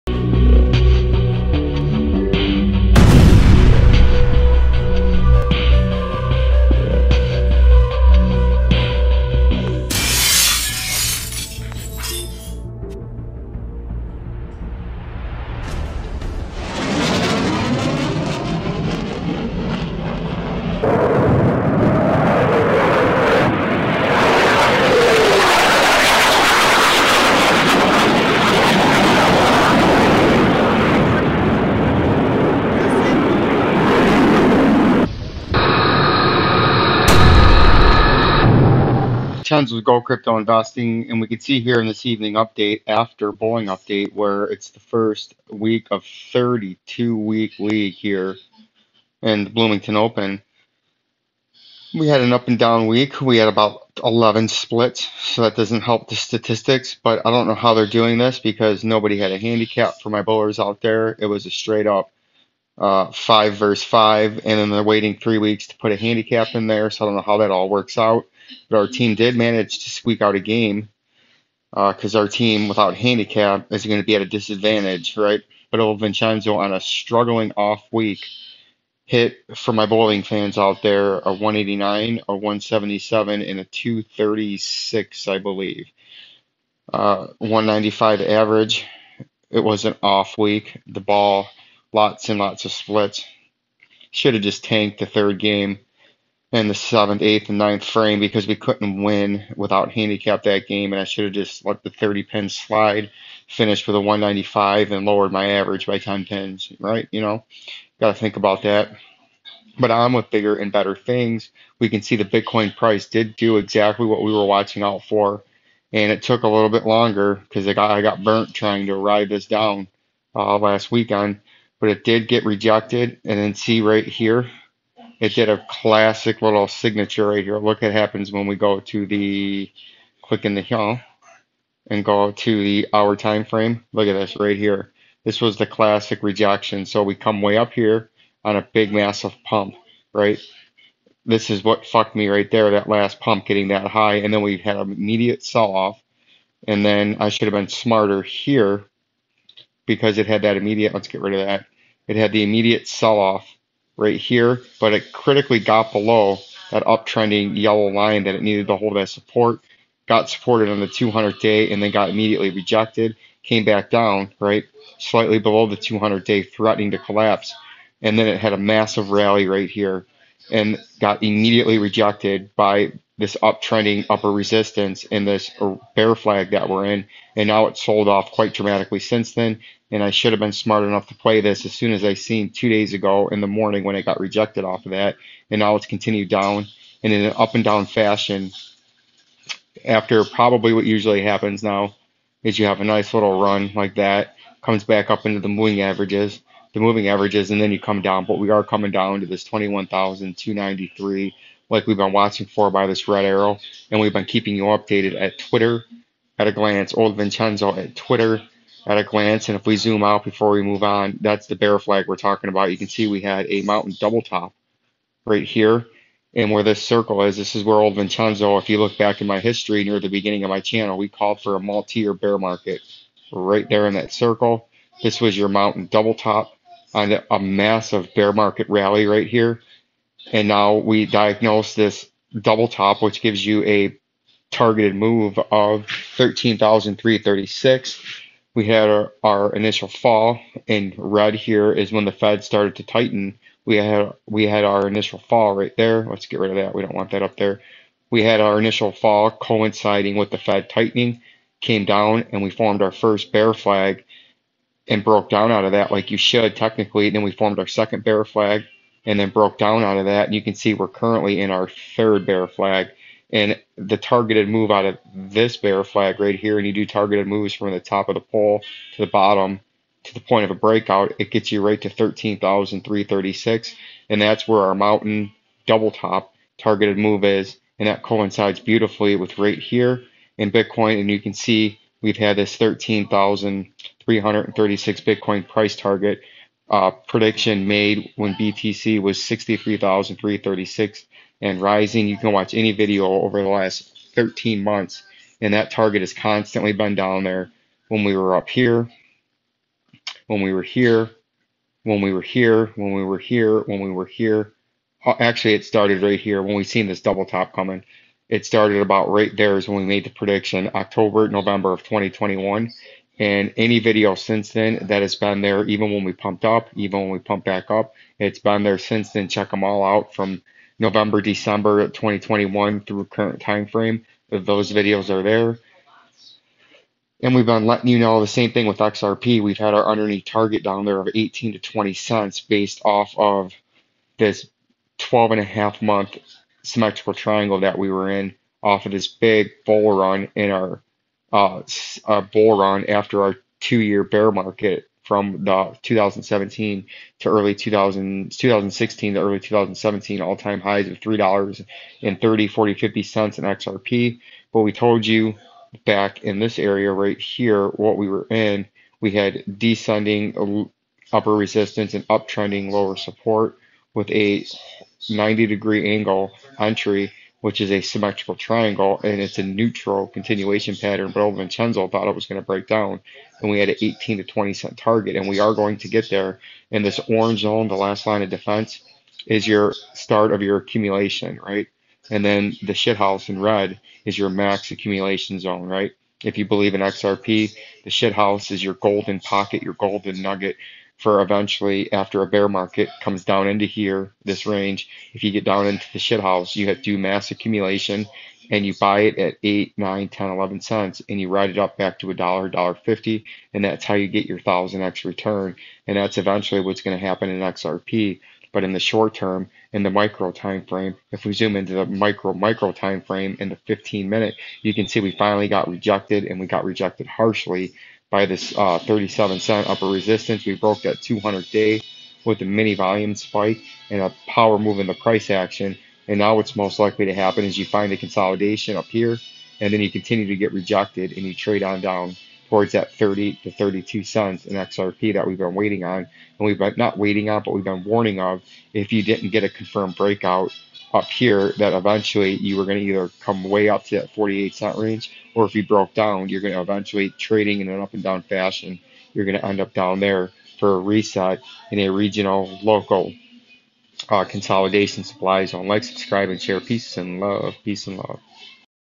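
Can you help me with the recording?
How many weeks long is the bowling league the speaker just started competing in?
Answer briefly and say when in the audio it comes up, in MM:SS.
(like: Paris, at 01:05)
32, at 00:46.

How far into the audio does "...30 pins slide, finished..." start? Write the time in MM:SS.
01:41.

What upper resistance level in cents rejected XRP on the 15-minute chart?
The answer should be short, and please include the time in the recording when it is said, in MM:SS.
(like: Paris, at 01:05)
37 cents, at 06:58.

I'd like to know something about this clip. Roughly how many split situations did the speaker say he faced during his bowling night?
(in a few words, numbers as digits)
11.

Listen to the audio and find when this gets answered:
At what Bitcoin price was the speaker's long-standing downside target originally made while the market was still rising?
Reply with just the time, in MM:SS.
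04:49.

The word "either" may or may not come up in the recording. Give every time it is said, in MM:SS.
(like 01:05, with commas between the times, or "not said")
07:22.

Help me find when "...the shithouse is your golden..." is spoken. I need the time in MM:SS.
06:27.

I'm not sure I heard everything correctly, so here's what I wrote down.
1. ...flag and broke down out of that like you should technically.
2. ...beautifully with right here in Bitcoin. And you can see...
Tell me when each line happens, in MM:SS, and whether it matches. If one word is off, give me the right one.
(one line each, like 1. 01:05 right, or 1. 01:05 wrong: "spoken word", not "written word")
1. 04:13 right
2. 04:38 right.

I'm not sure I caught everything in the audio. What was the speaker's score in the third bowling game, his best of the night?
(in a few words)
236.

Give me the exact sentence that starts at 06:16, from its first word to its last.
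And this orange zone, the last line of defense, is your start of your accumulation, right?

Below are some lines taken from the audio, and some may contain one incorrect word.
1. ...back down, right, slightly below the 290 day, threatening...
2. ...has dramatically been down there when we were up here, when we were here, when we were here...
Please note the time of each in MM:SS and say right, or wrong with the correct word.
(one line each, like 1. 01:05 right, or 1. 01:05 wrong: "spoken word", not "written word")
1. 02:43 wrong: "200", not "290"
2. 04:56 wrong: "constantly", not "dramatically".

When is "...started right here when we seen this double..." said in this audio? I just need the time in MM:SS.
05:05.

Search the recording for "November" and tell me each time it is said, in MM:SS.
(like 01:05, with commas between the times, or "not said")
05:11, 05:20.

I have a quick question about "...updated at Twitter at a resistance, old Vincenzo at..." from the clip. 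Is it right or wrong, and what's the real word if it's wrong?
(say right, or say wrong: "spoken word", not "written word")
wrong: "glance", not "resistance".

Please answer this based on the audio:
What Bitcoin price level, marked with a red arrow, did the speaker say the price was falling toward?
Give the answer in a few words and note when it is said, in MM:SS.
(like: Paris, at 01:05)
21,293, at 03:19.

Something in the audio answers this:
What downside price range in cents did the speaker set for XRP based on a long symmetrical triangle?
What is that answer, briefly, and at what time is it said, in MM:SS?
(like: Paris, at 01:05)
18 to 20 cents, at 05:31.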